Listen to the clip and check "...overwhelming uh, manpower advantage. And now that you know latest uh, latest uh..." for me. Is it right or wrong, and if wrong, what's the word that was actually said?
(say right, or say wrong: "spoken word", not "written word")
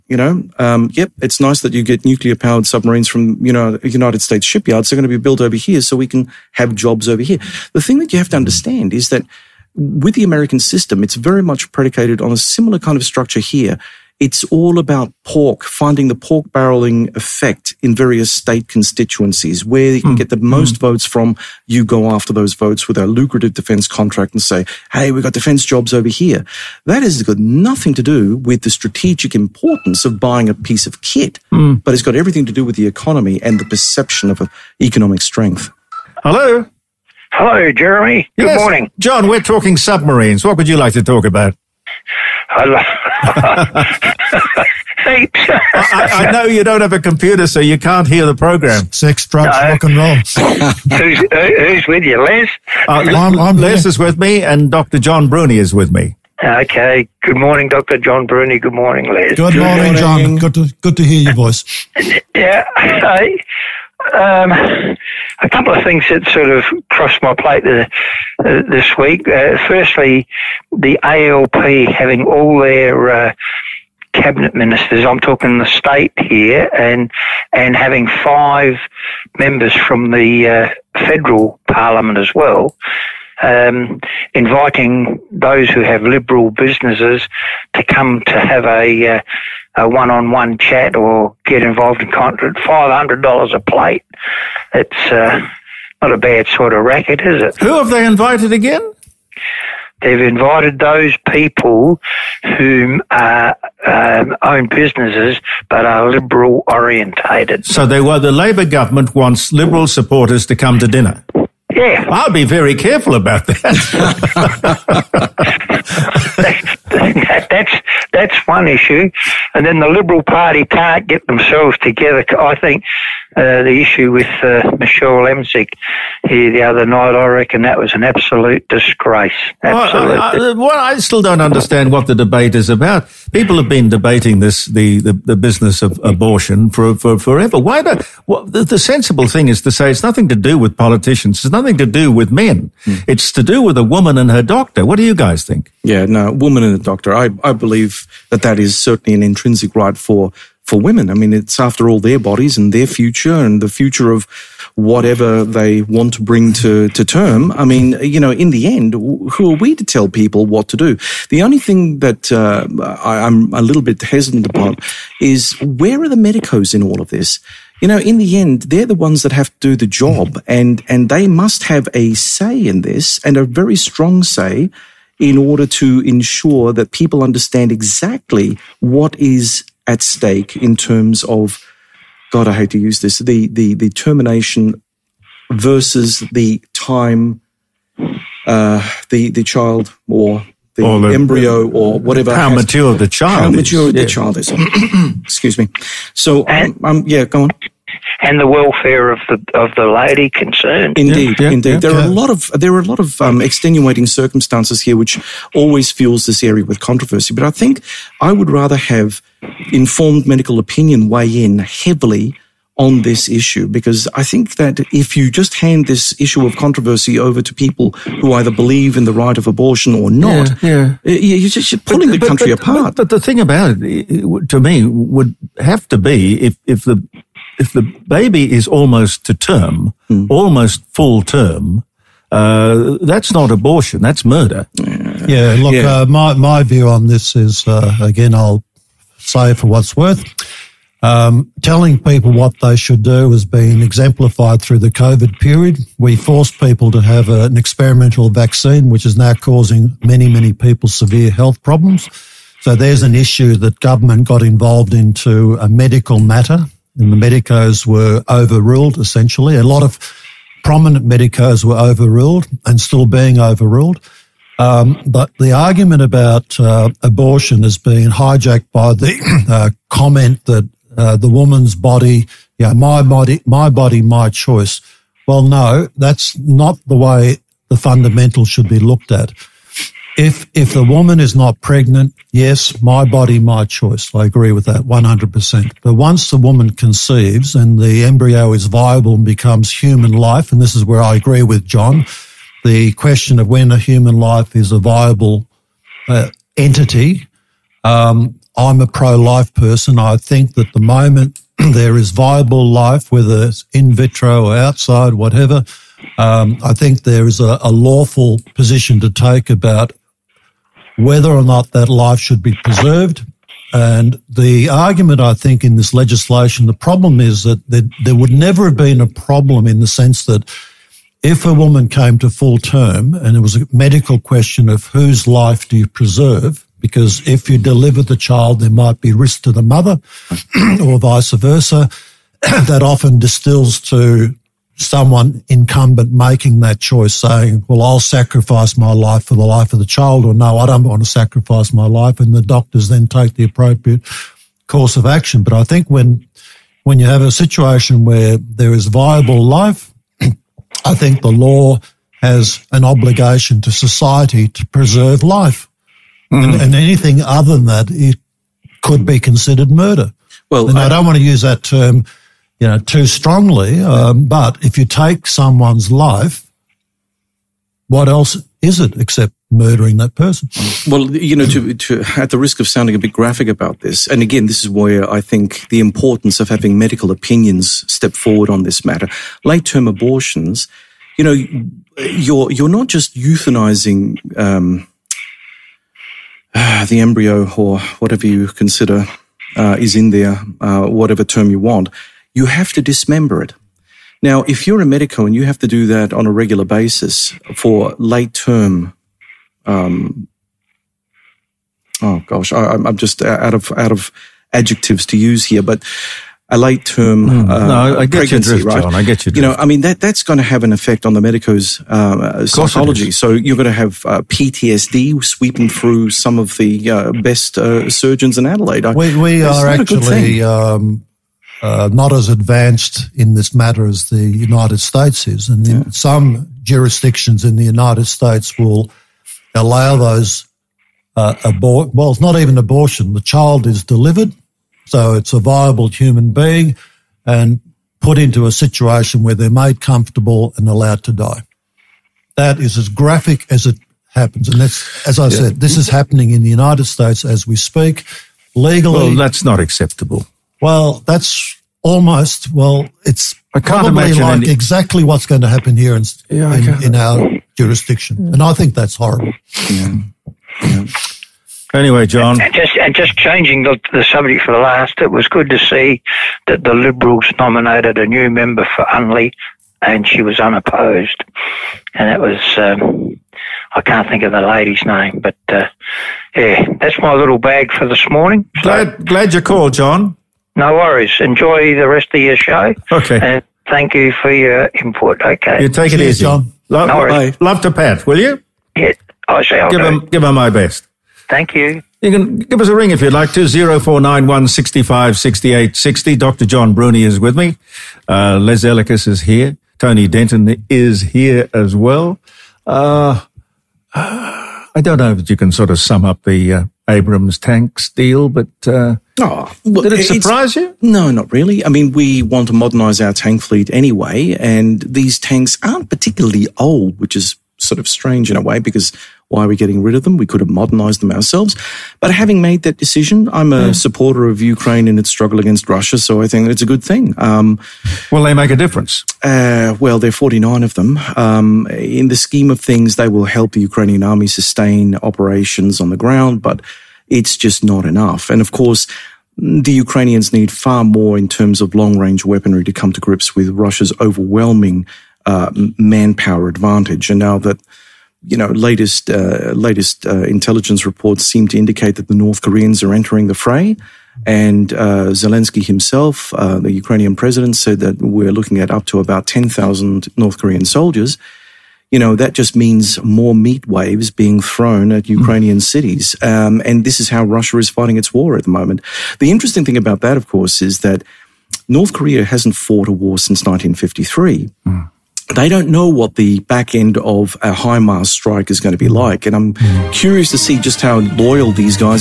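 right.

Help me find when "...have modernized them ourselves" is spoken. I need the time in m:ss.
8:40.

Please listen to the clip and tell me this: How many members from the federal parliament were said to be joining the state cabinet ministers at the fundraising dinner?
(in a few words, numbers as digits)
5.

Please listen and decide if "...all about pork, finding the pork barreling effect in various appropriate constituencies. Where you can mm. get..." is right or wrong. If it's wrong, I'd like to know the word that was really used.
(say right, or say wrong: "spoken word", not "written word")
wrong: "state", not "appropriate".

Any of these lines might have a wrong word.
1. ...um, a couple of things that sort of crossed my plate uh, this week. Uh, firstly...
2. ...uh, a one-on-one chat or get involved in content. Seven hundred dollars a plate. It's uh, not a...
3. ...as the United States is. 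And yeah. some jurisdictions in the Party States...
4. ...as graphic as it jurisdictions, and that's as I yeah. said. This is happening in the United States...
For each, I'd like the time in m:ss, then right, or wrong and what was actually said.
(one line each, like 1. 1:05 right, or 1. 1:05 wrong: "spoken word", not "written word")
1. 1:04 right
2. 1:29 wrong: "Five", not "Seven"
3. 7:03 wrong: "United", not "Party"
4. 7:22 wrong: "happens", not "jurisdictions".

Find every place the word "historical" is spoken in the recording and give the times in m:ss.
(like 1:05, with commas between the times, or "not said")
not said.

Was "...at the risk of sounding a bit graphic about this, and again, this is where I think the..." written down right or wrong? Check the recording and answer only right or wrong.
right.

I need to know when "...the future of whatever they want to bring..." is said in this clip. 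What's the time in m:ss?
2:33.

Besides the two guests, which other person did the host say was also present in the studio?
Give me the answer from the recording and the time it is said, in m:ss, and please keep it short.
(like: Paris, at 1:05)
Tony Denton, at 8:19.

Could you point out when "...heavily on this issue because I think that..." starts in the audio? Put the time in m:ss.
3:31.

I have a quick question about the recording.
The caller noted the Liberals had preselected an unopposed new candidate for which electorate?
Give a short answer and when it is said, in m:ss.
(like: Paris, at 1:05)
Unley, at 7:48.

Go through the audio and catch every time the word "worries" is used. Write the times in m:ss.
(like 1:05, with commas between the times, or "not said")
8:00, 8:06.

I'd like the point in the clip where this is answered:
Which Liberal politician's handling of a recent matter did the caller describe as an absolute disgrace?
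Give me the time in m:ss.
2:04.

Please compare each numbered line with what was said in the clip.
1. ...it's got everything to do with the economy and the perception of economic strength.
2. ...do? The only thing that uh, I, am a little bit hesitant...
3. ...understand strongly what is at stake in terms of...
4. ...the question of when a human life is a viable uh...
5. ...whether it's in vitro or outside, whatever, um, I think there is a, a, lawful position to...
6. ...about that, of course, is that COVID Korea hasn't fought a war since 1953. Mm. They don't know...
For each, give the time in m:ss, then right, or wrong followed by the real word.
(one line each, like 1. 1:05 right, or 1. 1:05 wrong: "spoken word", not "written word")
1. 0:31 right
2. 2:40 right
3. 2:57 wrong: "exactly", not "strongly"
4. 4:52 right
5. 5:03 right
6. 9:29 wrong: "North", not "COVID".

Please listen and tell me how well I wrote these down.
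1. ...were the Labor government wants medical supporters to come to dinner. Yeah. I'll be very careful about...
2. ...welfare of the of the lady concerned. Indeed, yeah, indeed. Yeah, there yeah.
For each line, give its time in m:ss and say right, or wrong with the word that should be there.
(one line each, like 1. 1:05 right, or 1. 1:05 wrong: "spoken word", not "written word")
1. 1:48 wrong: "liberal", not "medical"
2. 3:18 right.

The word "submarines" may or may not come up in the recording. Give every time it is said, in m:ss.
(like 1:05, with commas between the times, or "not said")
0:02, 0:39.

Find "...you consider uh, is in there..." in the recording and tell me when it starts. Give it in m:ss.
6:28.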